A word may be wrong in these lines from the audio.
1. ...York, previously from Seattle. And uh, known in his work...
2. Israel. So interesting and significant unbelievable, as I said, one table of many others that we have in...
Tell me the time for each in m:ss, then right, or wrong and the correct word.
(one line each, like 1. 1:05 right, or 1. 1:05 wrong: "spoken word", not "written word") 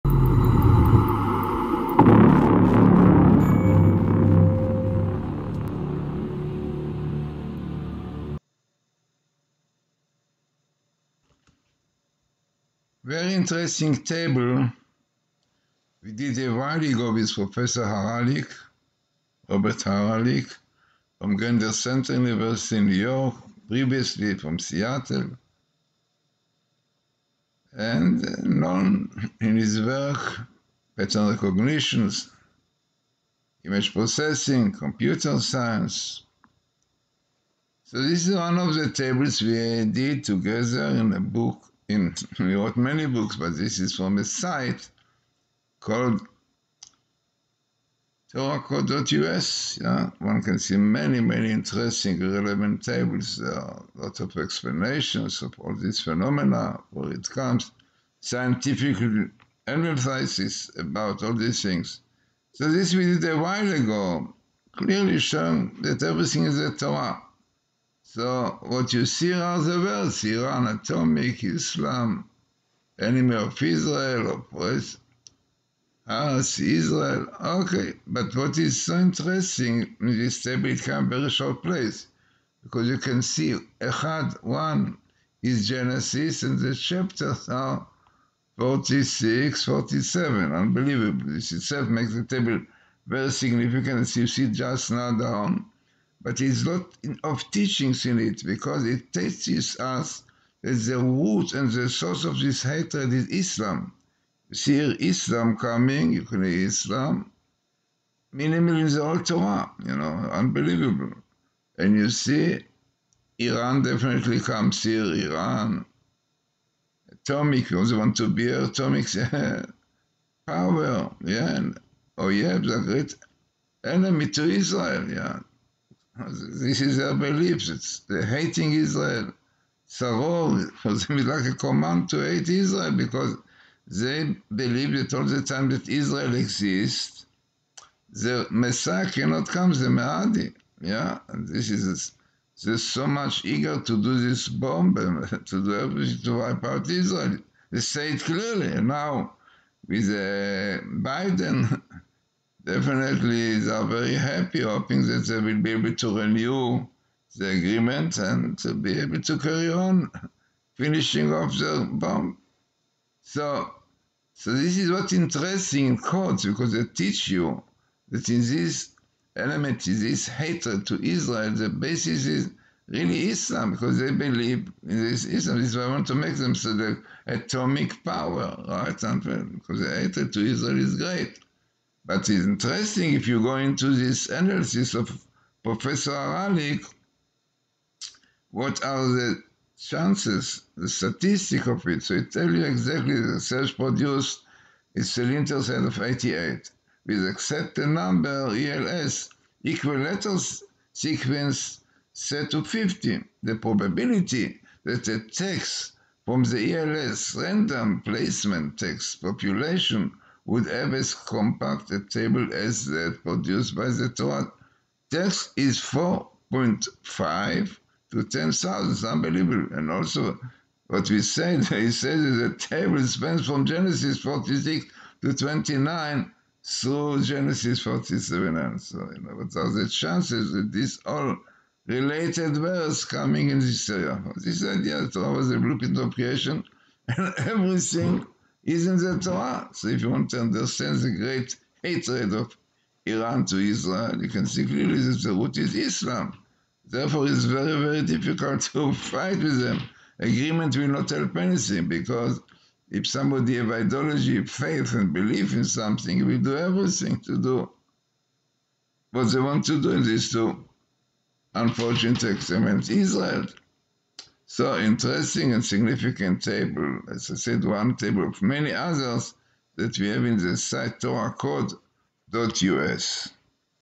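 1. 0:22 right
2. 4:22 wrong: "table", not "unbelievable".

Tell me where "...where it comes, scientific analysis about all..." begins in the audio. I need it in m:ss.
0:56.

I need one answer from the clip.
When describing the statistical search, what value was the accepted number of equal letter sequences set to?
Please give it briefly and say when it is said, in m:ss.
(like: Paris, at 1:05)
50, at 3:22.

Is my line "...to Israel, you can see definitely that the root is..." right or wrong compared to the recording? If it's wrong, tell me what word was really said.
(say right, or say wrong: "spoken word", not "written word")
wrong: "clearly", not "definitely".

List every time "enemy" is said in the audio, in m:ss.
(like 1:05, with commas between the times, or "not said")
1:12, 2:03.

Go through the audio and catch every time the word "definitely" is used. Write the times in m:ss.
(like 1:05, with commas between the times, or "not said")
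1:53, 2:32.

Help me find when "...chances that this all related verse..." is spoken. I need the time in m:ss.
3:49.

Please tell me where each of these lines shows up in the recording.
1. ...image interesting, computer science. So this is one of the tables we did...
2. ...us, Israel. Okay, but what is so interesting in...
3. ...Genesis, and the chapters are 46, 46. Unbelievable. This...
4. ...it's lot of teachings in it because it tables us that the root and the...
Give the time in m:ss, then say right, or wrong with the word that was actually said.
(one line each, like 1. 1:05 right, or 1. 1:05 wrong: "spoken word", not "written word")
1. 0:33 wrong: "processing", not "interesting"
2. 1:16 right
3. 1:25 wrong: "47", not "46"
4. 1:36 wrong: "teaches", not "tables".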